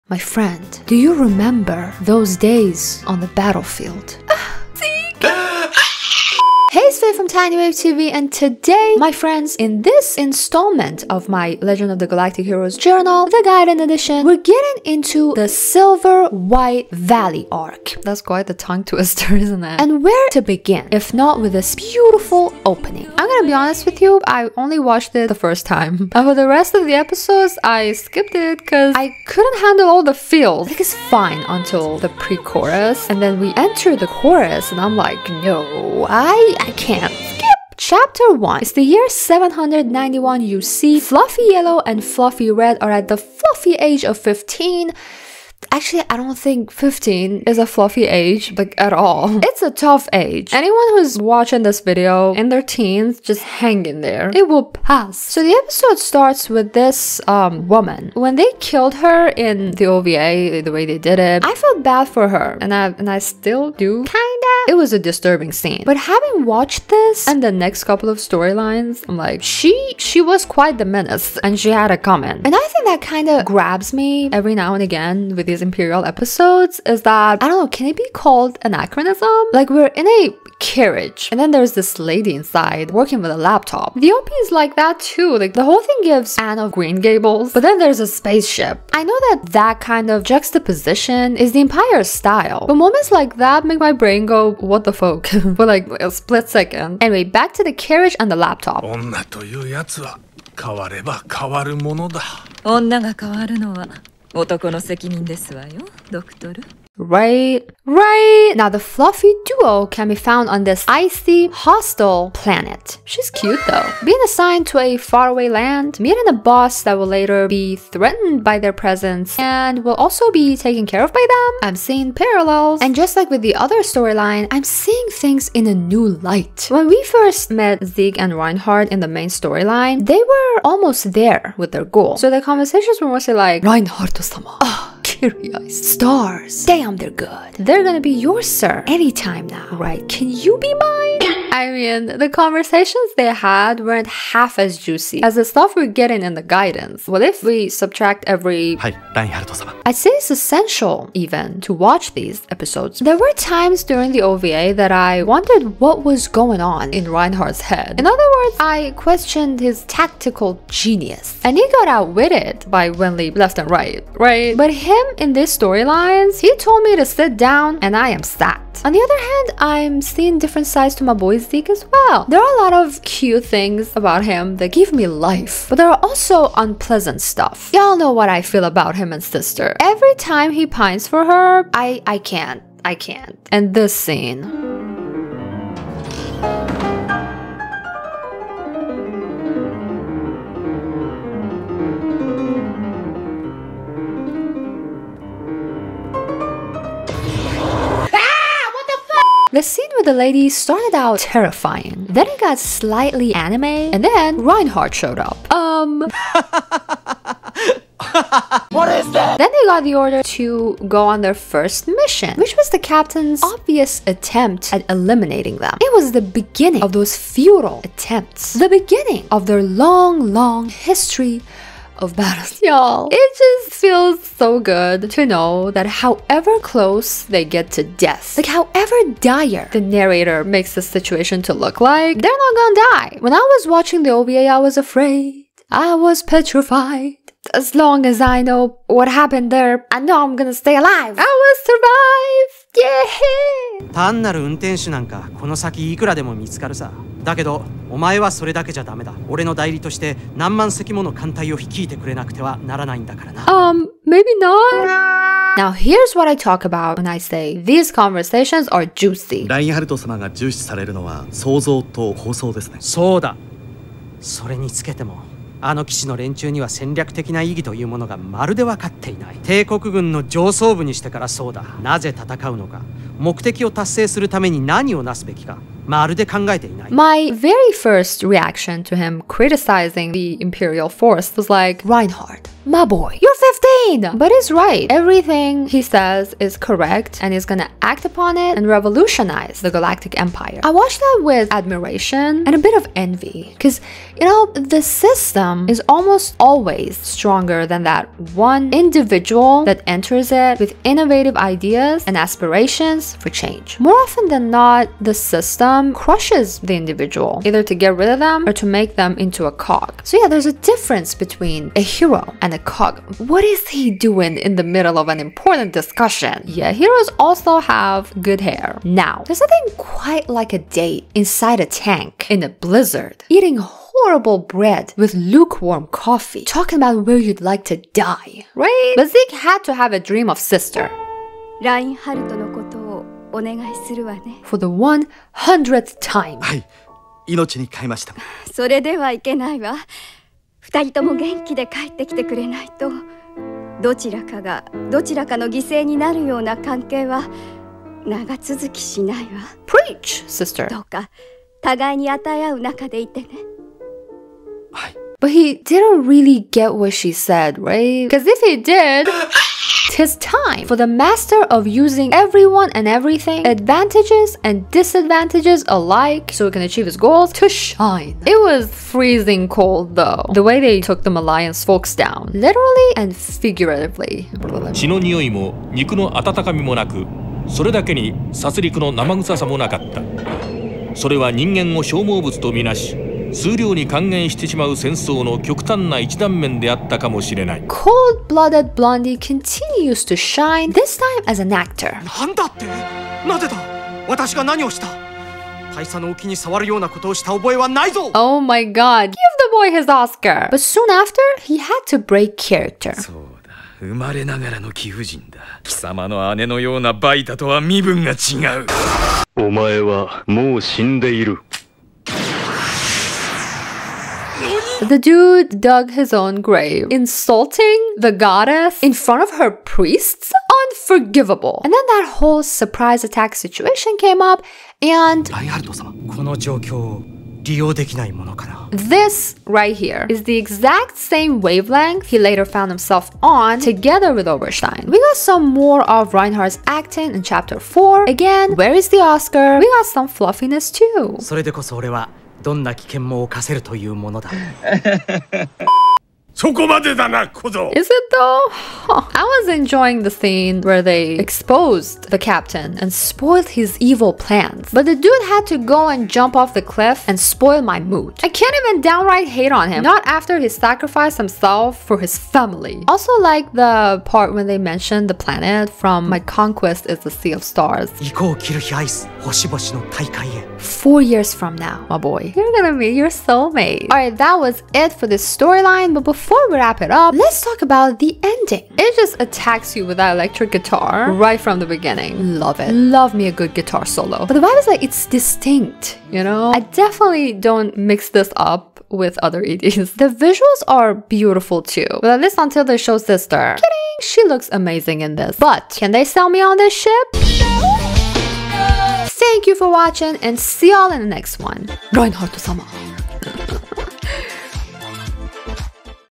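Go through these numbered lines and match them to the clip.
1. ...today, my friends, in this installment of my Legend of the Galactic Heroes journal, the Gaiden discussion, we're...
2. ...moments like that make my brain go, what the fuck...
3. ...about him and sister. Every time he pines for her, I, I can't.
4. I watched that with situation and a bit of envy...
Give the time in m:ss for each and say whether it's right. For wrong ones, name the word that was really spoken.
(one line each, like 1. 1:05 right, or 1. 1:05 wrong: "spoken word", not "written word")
1. 0:08 wrong: "edition", not "discussion"
2. 1:32 right
3. 2:58 right
4. 4:50 wrong: "admiration", not "situation".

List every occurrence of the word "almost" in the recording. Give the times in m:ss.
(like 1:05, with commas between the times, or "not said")
2:10, 4:55.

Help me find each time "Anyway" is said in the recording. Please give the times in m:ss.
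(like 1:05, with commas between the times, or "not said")
1:37.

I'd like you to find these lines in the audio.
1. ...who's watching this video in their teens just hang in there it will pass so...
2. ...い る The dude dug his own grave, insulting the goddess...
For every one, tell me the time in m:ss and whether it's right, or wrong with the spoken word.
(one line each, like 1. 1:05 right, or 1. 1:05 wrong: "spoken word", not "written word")
1. 0:50 right
2. 6:51 right.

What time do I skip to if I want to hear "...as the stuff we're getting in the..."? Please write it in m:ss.
2:25.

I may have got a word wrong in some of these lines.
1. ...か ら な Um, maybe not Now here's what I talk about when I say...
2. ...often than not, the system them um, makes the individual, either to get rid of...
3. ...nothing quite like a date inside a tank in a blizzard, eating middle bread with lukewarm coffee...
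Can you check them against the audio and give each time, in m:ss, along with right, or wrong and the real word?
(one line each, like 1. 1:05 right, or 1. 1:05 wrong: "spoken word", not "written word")
1. 4:13 right
2. 5:04 wrong: "crushes", not "makes"
3. 5:19 wrong: "horrible", not "middle".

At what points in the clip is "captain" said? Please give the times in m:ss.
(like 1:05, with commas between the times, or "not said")
3:32, 7:32.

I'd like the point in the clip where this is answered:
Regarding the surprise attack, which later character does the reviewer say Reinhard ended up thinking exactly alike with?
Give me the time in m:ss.
7:14.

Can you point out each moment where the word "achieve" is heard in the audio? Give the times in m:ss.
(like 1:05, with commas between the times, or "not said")
6:06.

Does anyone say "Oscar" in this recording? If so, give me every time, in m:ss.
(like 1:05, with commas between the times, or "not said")
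6:39, 7:18.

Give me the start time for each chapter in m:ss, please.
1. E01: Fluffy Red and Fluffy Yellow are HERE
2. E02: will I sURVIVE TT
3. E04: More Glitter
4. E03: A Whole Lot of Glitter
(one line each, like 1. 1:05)
1. 0:37
2. 4:03
3. 7:14
4. 6:08.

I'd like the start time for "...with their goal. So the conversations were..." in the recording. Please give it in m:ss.
2:11.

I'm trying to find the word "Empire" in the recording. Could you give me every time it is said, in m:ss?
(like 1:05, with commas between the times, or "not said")
1:31, 4:50.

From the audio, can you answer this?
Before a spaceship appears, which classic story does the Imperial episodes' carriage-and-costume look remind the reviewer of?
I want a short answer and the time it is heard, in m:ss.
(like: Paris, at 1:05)
Anne of Green Gables, at 1:26.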